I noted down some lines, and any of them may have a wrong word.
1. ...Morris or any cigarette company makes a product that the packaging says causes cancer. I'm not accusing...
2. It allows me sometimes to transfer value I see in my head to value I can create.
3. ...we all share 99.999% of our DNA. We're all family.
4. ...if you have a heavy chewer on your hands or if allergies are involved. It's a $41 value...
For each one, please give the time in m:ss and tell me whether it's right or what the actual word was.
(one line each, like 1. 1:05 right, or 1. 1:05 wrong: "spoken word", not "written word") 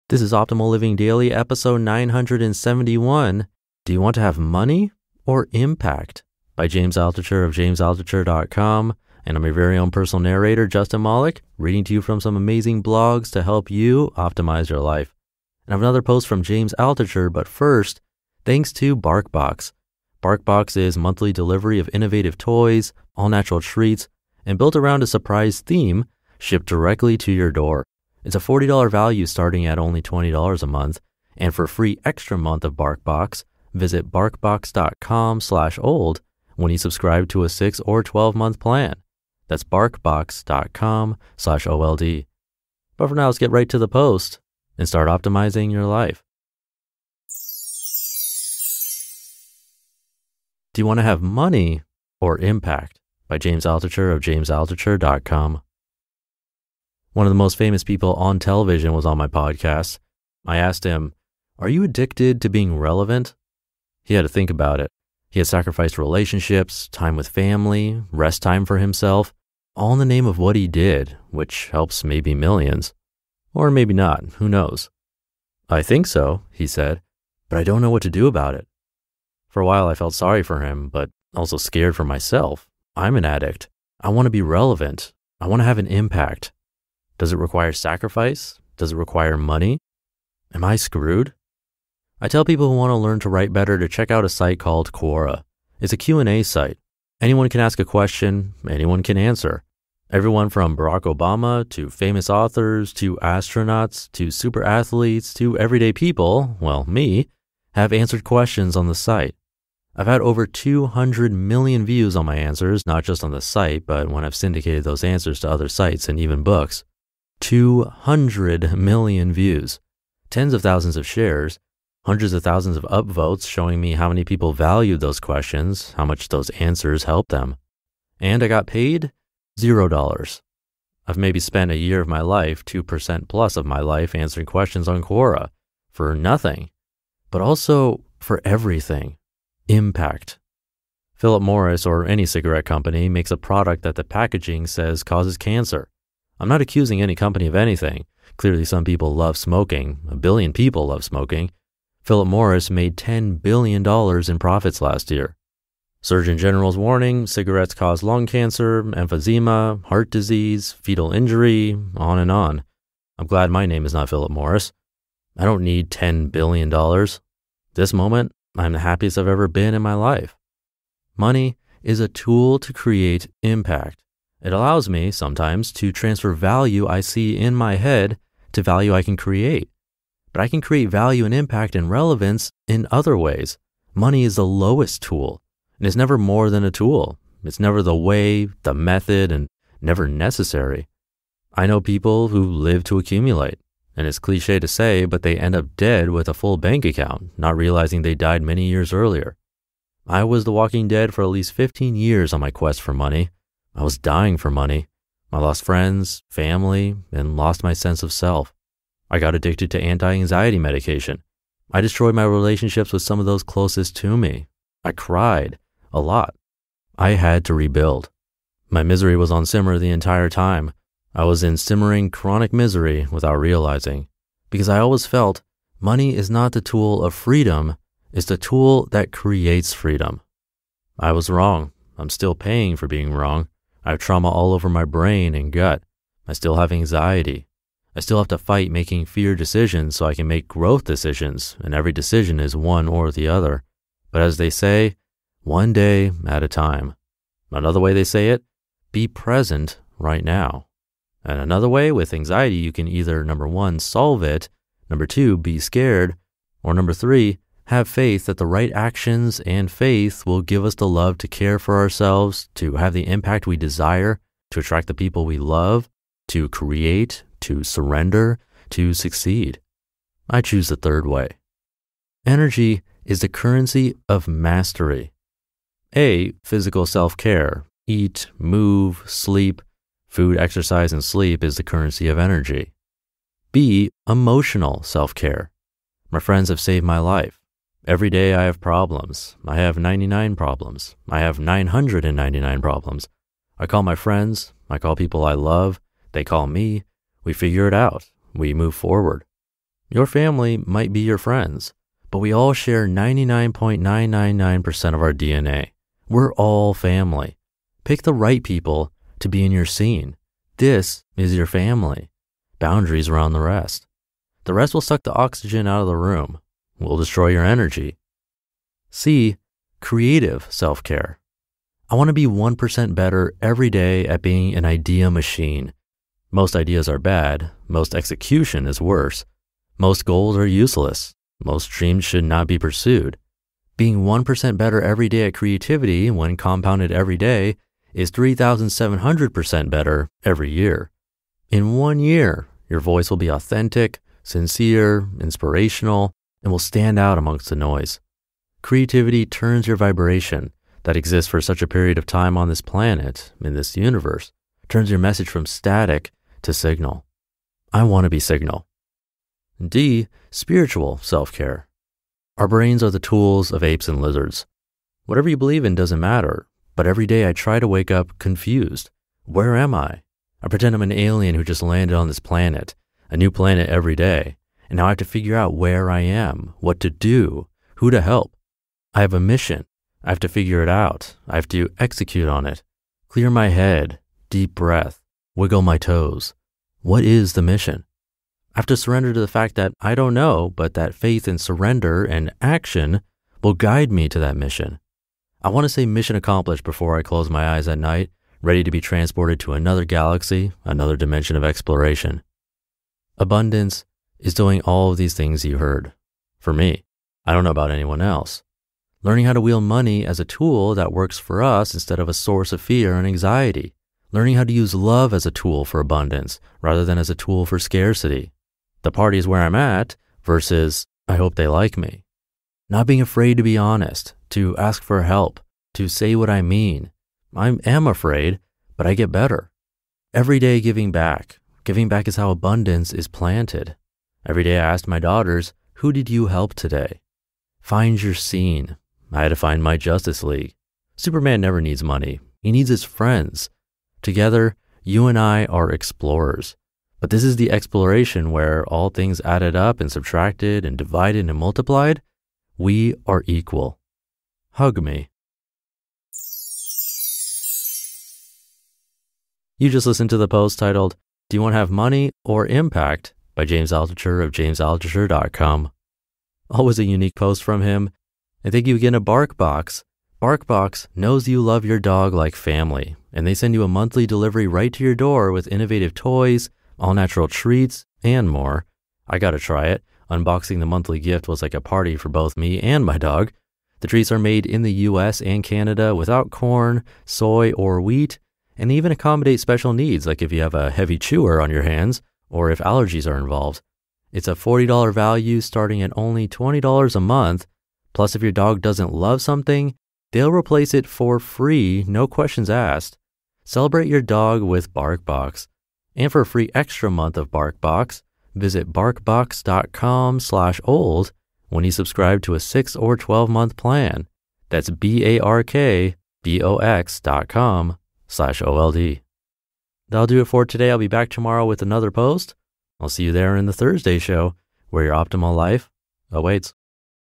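1. 2:21 right
2. 2:54 right
3. 5:02 right
4. 8:10 wrong: "40", not "41".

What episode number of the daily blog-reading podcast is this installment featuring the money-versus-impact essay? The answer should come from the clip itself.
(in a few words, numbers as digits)
971.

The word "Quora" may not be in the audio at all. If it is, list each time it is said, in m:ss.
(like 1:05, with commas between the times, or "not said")
1:34, 2:15.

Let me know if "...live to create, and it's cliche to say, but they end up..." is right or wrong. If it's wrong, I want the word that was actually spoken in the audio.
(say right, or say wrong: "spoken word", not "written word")
wrong: "accumulate", not "create".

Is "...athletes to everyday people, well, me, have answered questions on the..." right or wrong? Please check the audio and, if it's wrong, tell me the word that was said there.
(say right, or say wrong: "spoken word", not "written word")
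right.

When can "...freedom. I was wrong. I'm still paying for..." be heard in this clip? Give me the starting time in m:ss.
3:49.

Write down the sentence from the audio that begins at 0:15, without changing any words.
And I have another post from James Altucher, but first, thanks to Barkbox.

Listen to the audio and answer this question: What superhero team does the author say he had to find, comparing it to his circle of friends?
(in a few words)
Justice League.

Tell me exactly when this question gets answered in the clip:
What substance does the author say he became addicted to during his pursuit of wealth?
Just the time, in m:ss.
3:29.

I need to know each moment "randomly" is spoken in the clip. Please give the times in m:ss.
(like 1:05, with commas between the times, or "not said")
not said.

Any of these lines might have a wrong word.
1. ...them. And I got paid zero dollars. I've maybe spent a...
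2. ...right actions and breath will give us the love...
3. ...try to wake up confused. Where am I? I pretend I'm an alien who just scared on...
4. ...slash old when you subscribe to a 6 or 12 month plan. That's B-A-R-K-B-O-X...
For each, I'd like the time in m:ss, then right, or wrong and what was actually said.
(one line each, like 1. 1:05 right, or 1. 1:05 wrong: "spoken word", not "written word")
1. 2:07 right
2. 4:18 wrong: "faith", not "breath"
3. 6:07 wrong: "landed", not "scared"
4. 8:30 right.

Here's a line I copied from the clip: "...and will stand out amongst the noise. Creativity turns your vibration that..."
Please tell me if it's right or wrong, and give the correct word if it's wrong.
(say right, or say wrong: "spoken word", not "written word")
right.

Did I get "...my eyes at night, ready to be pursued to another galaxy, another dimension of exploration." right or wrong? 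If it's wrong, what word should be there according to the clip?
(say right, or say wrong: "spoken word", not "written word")
wrong: "transported", not "pursued".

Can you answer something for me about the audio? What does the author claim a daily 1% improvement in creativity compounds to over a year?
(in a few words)
3,700%.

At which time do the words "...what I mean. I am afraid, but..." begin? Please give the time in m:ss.
7:06.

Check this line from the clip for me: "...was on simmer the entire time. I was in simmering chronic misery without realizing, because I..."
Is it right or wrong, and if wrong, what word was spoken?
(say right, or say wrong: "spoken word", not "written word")
right.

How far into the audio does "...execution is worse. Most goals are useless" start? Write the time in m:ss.
5:27.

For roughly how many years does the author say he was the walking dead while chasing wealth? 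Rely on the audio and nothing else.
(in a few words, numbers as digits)
15 years.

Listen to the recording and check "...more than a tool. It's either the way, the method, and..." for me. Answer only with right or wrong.
wrong.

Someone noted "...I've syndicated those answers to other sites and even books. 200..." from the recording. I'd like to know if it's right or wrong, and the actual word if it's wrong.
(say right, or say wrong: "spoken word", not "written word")
right.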